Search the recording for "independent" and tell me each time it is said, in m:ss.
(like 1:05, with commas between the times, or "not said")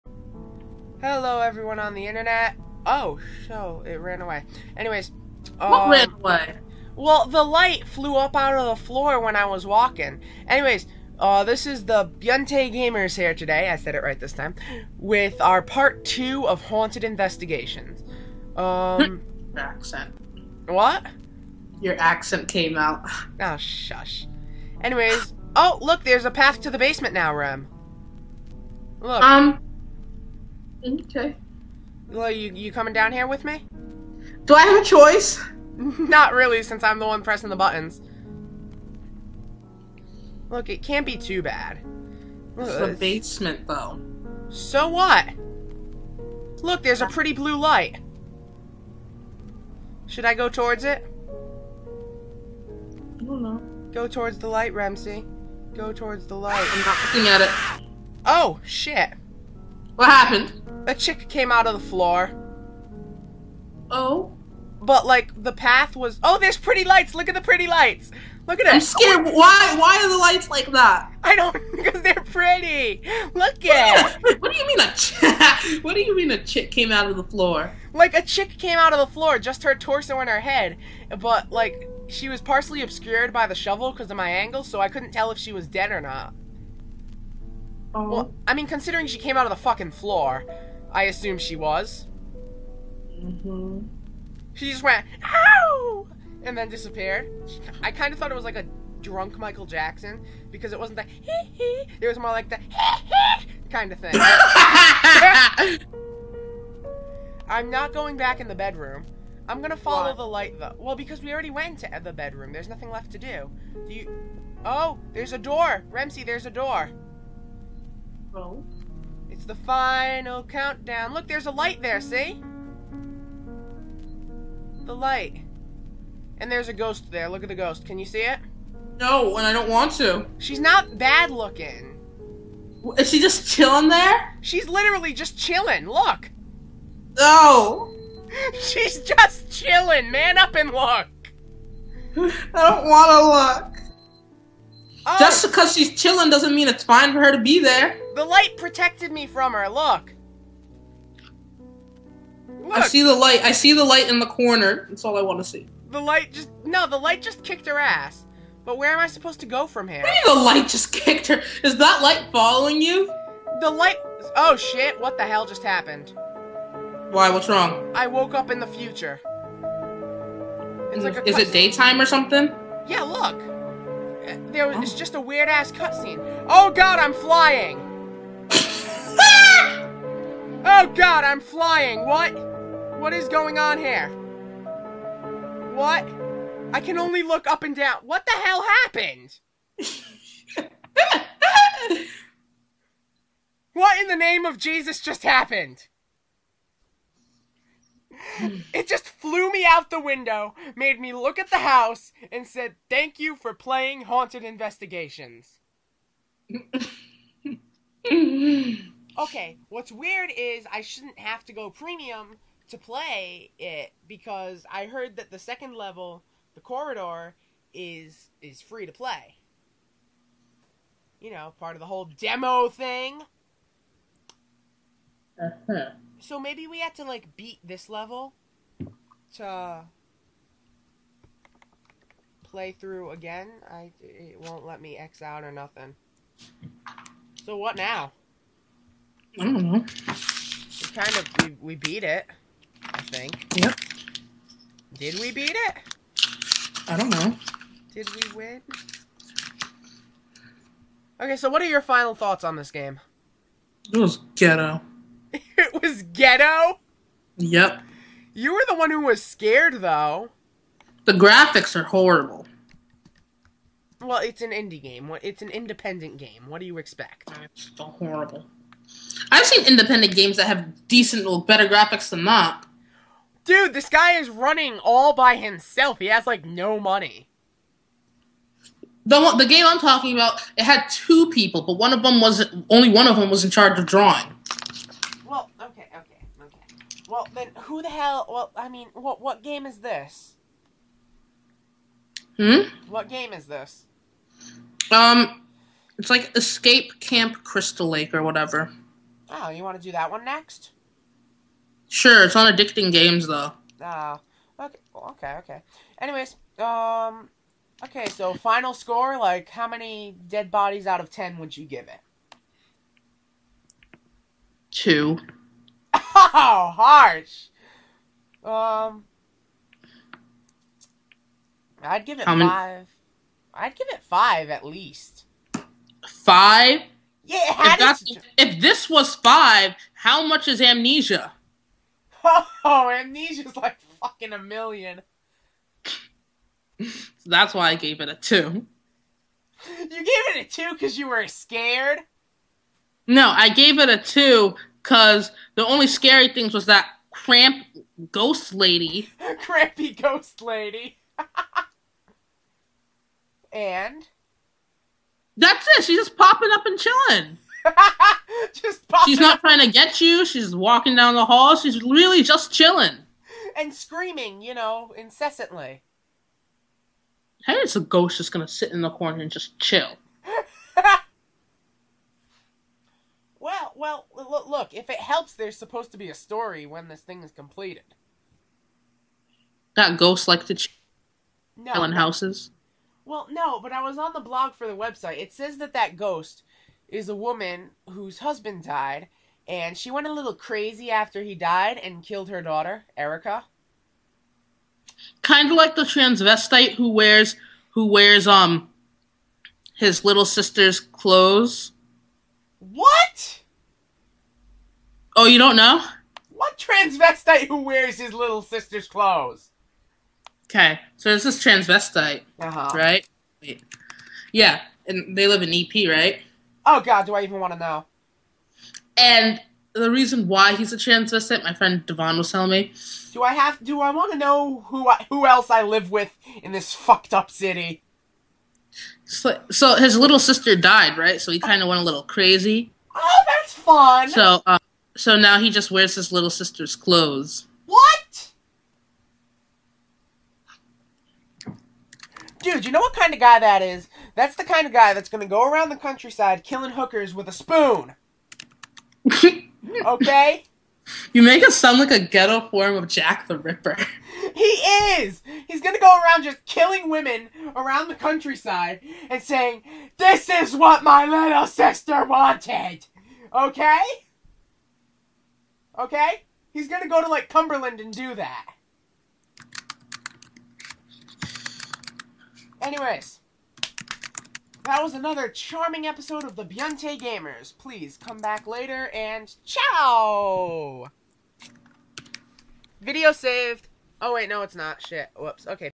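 4:25, 4:29.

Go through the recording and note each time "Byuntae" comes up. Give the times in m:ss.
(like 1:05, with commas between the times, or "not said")
0:12, 7:56.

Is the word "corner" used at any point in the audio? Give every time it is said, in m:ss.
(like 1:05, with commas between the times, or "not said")
2:34, 6:08.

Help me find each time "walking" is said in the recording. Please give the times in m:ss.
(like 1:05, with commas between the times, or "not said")
0:09, 6:00.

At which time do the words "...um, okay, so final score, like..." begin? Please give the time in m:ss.
5:06.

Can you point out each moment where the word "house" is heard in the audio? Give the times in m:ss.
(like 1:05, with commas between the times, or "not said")
3:21, 6:21.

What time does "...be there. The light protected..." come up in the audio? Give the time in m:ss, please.
2:27.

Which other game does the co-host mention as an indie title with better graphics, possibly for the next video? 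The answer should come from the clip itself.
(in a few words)
Escape Camp Crystal Lake.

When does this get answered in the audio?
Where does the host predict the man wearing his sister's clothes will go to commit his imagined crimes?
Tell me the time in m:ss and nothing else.
7:47.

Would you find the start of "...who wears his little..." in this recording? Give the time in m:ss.
6:47.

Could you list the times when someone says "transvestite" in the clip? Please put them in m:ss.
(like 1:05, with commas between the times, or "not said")
6:35, 6:46, 6:51, 7:00.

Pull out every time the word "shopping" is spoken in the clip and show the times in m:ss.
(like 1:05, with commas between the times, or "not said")
not said.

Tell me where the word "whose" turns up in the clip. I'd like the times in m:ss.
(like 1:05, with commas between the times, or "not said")
6:27.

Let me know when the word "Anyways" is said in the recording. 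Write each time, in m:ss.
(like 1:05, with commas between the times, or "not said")
0:04, 0:10, 0:24, 5:05, 7:52.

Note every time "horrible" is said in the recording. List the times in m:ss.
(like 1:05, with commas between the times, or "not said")
4:21, 4:27.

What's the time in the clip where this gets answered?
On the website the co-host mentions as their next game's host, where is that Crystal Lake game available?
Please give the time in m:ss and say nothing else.
5:02.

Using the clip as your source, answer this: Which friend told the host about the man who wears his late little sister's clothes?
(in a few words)
Devon.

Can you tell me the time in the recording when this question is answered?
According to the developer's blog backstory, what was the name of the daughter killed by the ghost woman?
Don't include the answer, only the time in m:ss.
6:32.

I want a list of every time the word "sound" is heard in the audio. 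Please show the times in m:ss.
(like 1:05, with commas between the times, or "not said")
7:31.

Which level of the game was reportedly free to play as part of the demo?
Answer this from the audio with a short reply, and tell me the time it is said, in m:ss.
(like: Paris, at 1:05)
the corridor, at 3:36.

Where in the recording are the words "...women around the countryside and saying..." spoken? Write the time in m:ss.
7:36.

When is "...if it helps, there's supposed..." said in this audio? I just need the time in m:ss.
6:14.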